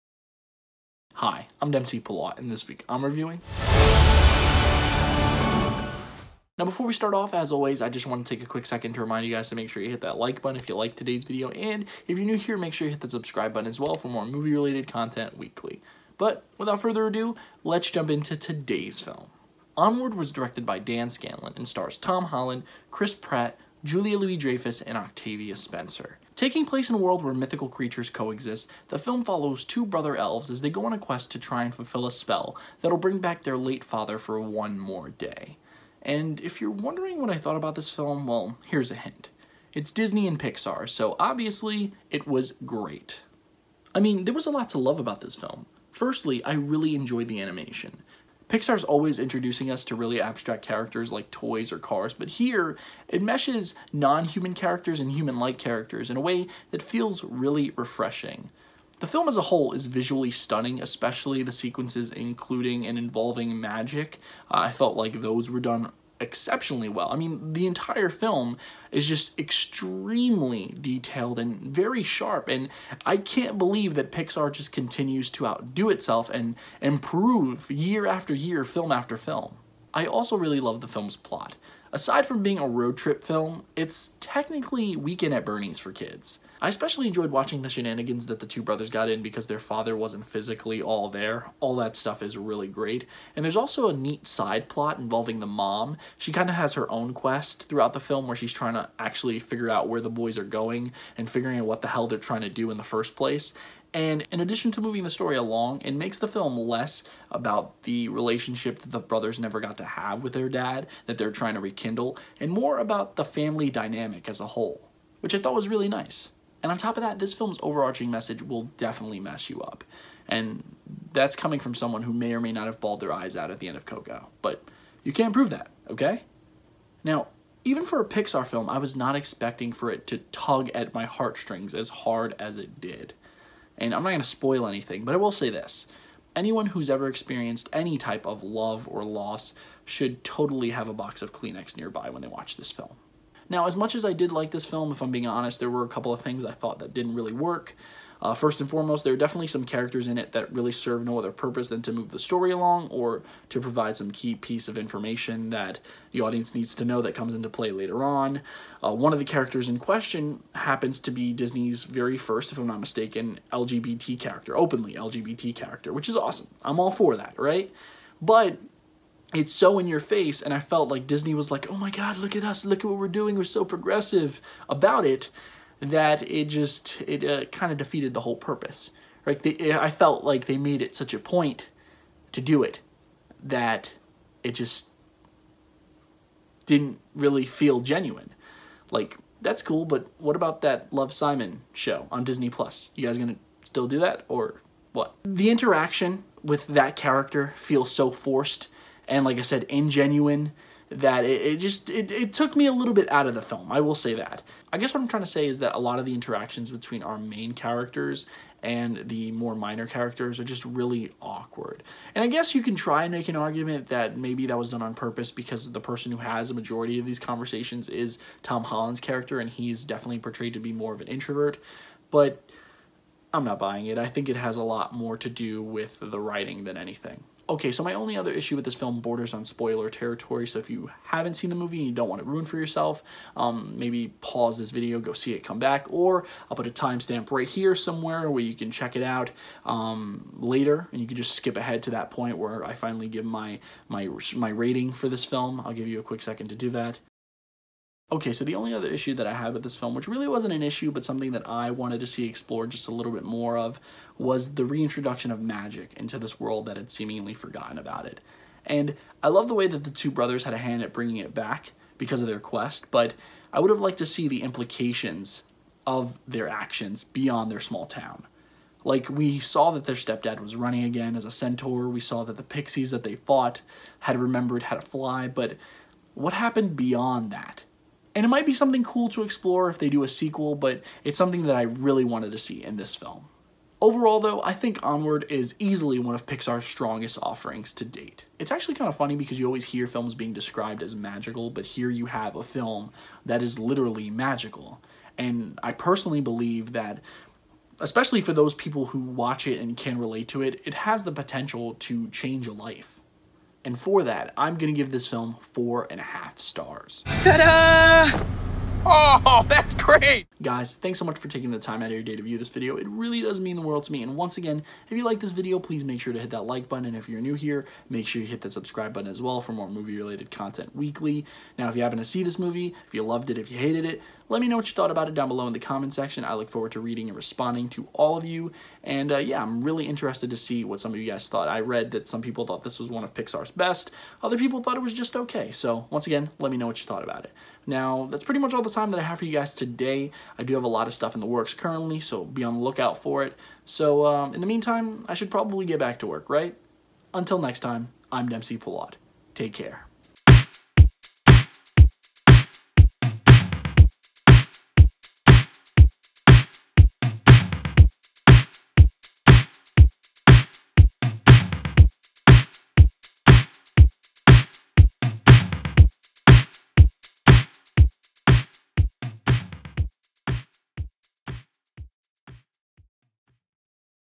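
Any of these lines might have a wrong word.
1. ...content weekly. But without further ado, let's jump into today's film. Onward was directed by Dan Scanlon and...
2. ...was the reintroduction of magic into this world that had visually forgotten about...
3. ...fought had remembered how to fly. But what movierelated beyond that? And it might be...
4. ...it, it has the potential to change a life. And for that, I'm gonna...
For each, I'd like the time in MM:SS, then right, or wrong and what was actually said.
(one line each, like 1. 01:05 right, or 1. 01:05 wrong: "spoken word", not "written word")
1. 00:14 right
2. 04:14 wrong: "seemingly", not "visually"
3. 04:33 wrong: "happened", not "movierelated"
4. 05:00 right.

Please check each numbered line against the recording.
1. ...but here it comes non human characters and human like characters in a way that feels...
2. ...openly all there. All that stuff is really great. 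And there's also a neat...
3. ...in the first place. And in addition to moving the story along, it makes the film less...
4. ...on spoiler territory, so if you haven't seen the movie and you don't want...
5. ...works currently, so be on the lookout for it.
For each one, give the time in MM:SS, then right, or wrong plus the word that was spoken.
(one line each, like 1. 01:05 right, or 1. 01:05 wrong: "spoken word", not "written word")
1. 00:52 wrong: "meshes", not "comes"
2. 01:30 wrong: "physically", not "openly"
3. 01:42 right
4. 03:49 right
5. 05:41 right.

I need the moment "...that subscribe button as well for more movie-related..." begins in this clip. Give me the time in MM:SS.
05:18.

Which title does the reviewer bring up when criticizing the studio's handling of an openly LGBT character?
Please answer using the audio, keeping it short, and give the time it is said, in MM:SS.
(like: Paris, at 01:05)
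Love Simon, at 03:10.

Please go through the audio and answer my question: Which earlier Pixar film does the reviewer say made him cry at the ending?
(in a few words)
Coco.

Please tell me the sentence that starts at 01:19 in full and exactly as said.
I also really love the film's plot.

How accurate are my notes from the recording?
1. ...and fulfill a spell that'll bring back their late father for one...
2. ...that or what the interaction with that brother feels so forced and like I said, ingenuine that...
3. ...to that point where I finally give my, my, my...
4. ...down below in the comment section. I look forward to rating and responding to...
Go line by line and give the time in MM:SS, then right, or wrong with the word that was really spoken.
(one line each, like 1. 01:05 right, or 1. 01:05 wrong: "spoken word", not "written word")
1. 00:31 right
2. 03:13 wrong: "character", not "brother"
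3. 04:01 right
4. 05:25 wrong: "reading", not "rating".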